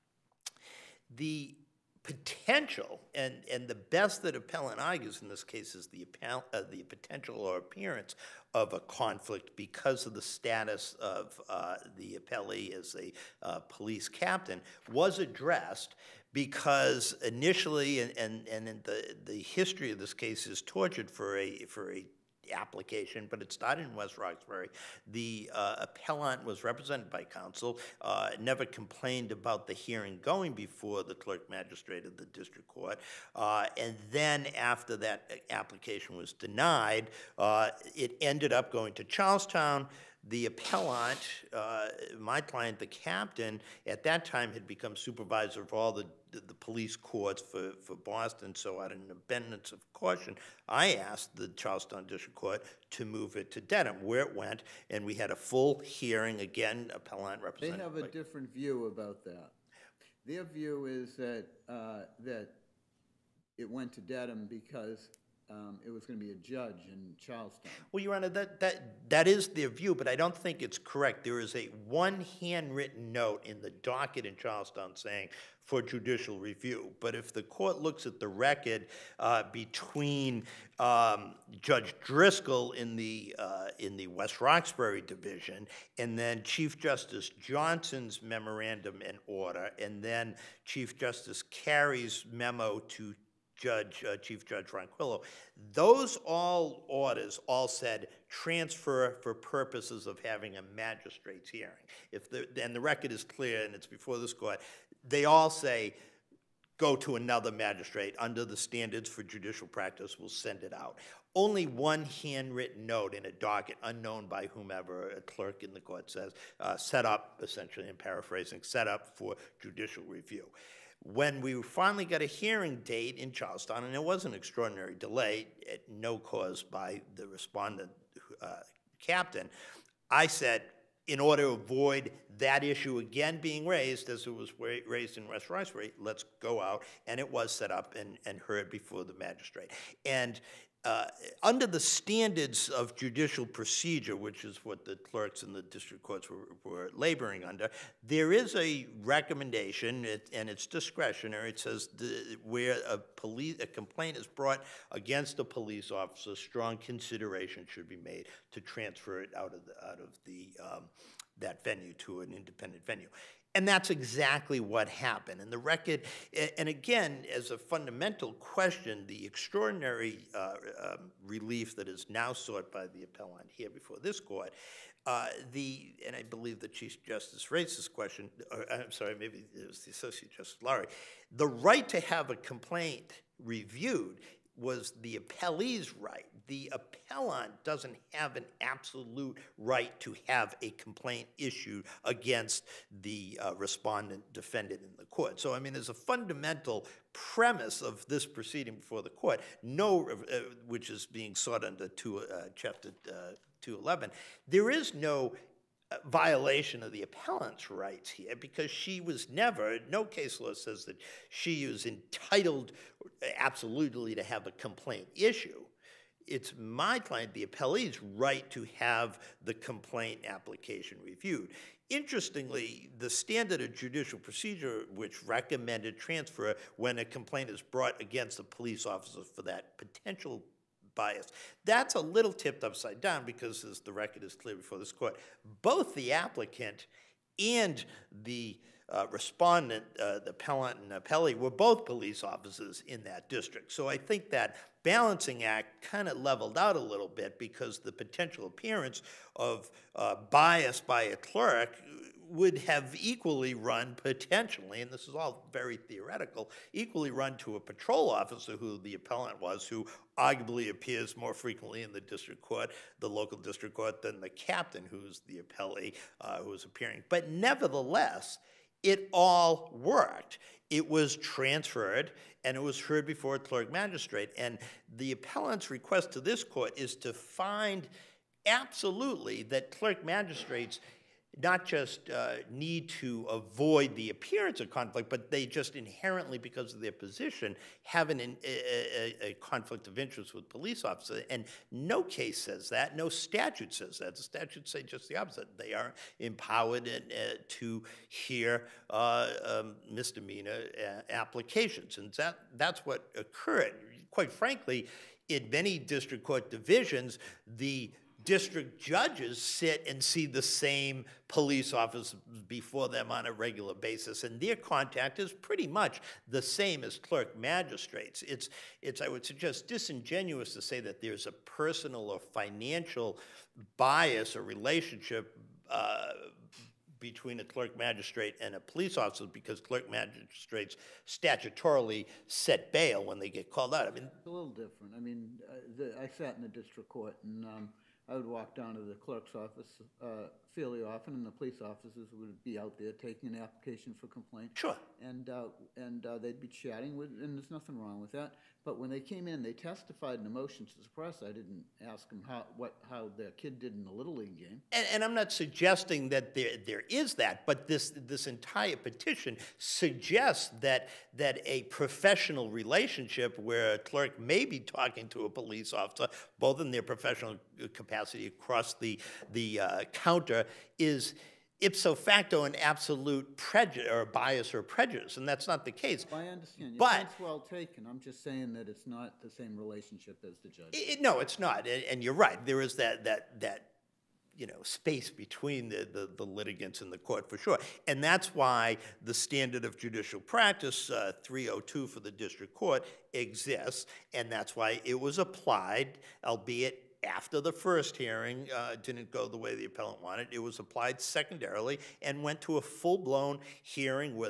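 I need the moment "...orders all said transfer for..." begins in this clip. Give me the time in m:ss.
1:36.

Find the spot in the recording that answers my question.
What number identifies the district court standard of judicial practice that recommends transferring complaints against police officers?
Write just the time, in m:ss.
6:31.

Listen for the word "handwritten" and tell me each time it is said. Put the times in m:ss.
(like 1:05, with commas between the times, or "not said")
1:12, 1:52.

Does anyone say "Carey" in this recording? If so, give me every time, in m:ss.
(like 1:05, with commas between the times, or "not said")
1:31.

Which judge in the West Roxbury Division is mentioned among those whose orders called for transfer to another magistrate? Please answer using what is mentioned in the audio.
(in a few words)
Judge Driscoll.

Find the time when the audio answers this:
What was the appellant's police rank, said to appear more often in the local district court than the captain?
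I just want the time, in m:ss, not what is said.
4:17.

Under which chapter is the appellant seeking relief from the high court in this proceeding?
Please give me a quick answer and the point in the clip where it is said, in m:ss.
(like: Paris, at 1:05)
Chapter 211, at 3:22.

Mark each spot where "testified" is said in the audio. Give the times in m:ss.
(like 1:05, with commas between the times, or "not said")
5:49.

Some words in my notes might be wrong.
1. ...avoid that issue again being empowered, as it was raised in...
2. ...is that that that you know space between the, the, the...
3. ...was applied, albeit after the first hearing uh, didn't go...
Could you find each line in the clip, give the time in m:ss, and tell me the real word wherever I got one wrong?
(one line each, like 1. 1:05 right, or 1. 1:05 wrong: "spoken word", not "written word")
1. 2:11 wrong: "raised", not "empowered"
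2. 6:22 right
3. 6:34 right.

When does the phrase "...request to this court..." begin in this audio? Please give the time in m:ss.
4:35.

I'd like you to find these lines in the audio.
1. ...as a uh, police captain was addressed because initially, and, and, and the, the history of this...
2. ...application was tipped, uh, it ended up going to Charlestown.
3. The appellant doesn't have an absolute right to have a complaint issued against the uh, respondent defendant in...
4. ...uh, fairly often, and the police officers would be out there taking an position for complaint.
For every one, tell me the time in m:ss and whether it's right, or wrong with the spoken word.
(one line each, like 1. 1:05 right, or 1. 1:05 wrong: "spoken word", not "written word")
1. 0:12 right
2. 0:35 wrong: "denied", not "tipped"
3. 3:06 right
4. 5:40 wrong: "application", not "position".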